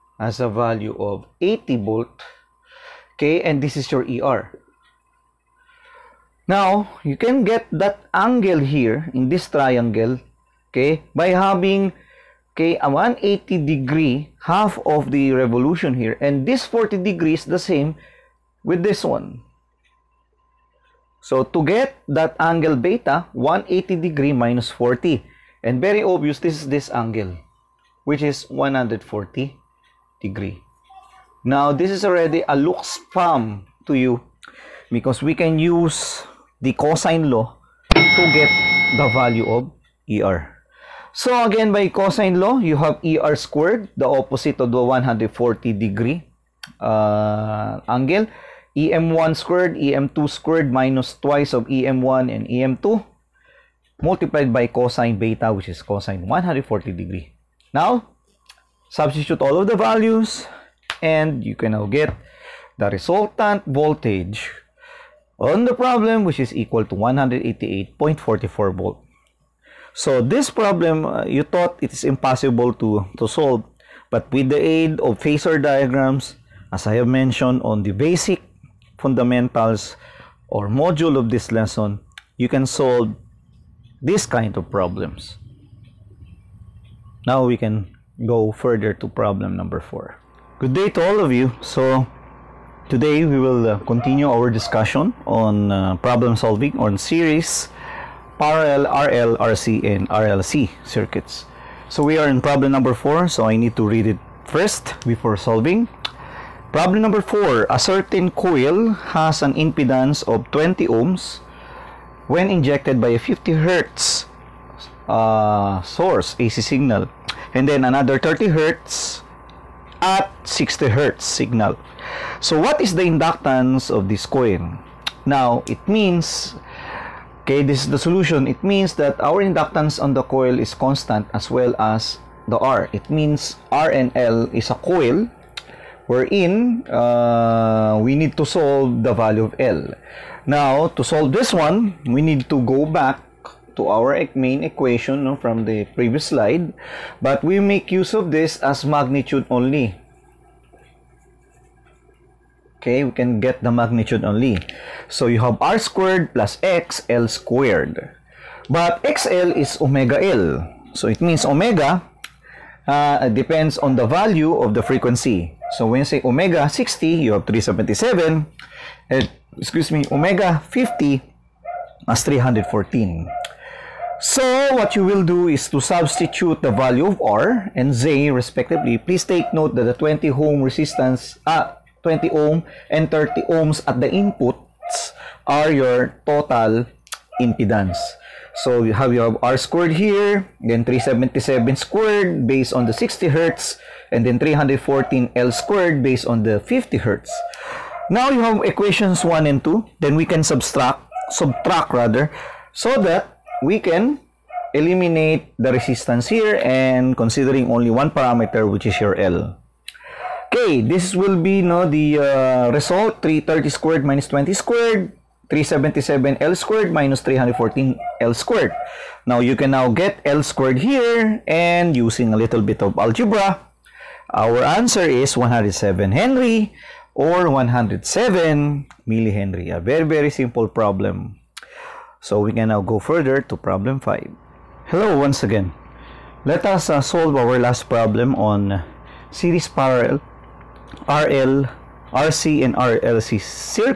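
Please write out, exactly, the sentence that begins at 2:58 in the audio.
Please take note that the 20 ohm resistance, ah, 20 ohm, and 30 ohms at the inputs are your total impedance.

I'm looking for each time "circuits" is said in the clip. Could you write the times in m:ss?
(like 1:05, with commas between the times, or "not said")
1:40, 4:03.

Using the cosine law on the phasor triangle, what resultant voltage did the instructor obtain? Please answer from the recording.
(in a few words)
188.44 volts.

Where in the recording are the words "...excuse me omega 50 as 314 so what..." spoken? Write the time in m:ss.
2:49.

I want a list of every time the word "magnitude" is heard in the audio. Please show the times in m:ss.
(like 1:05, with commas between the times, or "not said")
2:28, 2:33.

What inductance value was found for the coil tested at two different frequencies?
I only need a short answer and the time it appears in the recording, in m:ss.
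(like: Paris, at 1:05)
107 millihenry, at 3:47.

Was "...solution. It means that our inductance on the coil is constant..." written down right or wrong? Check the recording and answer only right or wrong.
right.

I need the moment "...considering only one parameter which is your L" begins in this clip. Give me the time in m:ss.
3:27.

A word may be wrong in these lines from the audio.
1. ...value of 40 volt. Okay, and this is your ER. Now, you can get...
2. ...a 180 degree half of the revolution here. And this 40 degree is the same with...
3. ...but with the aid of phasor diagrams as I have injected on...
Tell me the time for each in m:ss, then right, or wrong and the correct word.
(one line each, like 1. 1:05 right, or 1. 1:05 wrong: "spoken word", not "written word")
1. 0:00 wrong: "80", not "40"
2. 0:12 right
3. 1:14 wrong: "mentioned", not "injected".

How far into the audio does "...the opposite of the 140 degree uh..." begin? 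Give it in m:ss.
0:43.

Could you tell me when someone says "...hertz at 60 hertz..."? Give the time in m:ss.
1:58.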